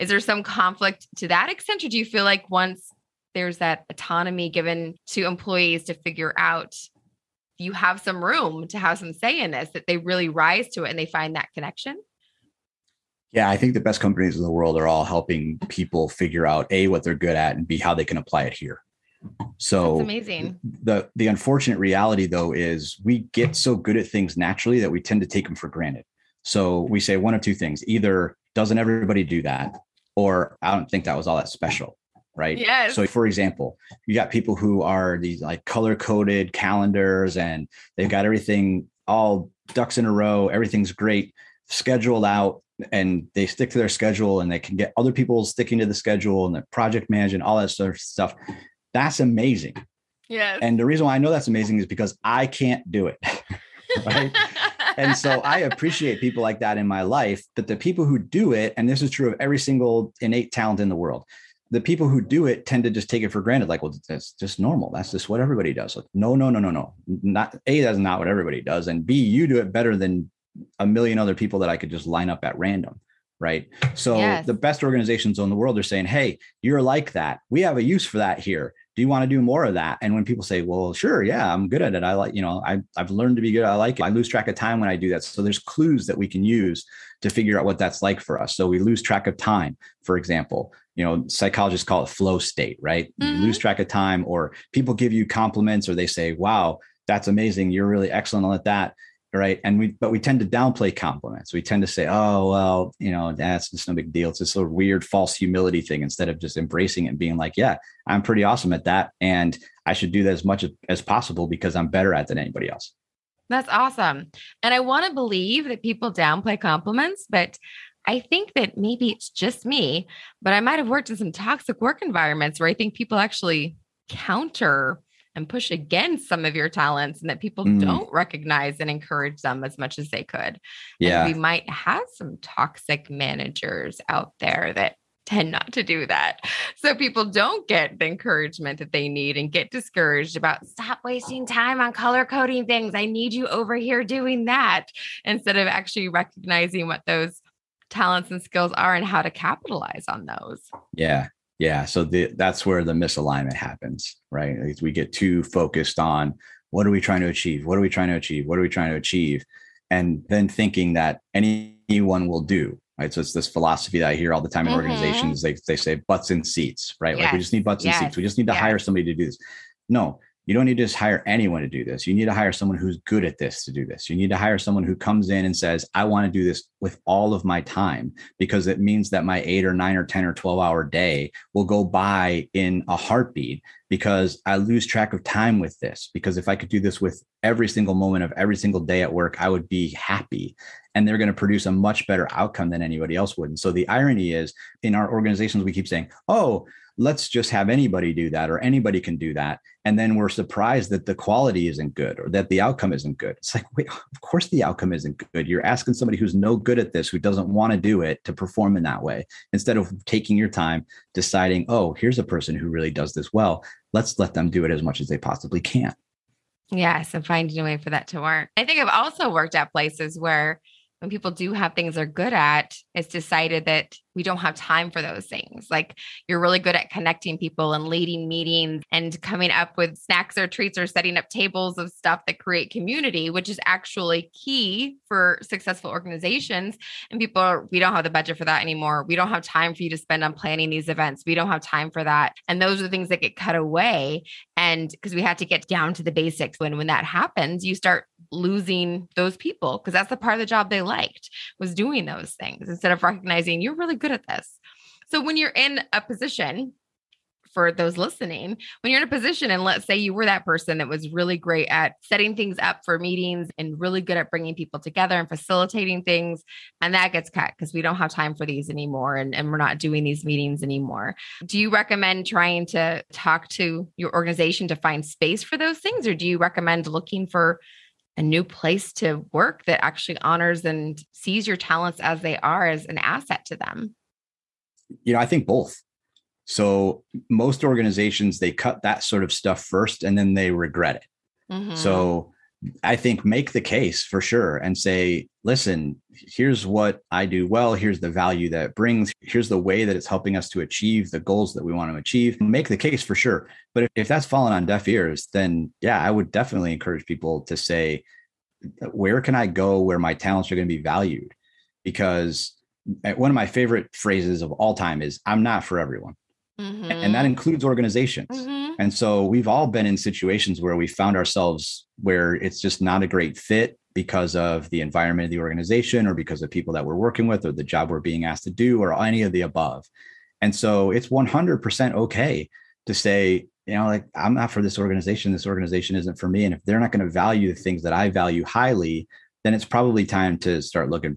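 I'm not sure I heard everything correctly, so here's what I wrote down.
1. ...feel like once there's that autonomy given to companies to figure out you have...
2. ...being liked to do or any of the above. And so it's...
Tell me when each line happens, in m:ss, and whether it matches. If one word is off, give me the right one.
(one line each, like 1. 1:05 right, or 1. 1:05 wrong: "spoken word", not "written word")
1. 0:02 wrong: "employees", not "companies"
2. 5:28 wrong: "asked", not "liked".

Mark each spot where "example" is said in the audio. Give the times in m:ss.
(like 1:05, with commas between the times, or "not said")
0:33, 1:30.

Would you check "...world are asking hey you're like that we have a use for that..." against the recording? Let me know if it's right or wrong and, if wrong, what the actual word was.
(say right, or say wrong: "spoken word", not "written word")
wrong: "saying", not "asking".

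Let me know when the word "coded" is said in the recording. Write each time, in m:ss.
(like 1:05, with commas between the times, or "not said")
0:35.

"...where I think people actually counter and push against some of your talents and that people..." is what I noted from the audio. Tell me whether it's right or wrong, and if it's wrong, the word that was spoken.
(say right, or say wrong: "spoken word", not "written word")
right.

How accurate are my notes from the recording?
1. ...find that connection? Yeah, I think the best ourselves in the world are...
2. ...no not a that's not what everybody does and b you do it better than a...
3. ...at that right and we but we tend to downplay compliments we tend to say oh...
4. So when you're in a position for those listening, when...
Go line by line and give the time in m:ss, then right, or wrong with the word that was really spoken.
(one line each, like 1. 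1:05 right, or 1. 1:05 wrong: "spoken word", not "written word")
1. 0:11 wrong: "companies", not "ourselves"
2. 1:06 right
3. 1:38 right
4. 4:15 right.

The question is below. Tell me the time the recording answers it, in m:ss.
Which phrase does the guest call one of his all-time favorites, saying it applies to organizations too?
5:15.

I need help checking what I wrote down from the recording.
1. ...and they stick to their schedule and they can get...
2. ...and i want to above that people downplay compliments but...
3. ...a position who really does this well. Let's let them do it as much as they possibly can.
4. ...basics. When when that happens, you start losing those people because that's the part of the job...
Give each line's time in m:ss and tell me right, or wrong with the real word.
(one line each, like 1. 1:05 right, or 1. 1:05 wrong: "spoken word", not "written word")
1. 0:42 right
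2. 1:54 wrong: "believe", not "above"
3. 3:32 wrong: "person", not "position"
4. 4:06 right.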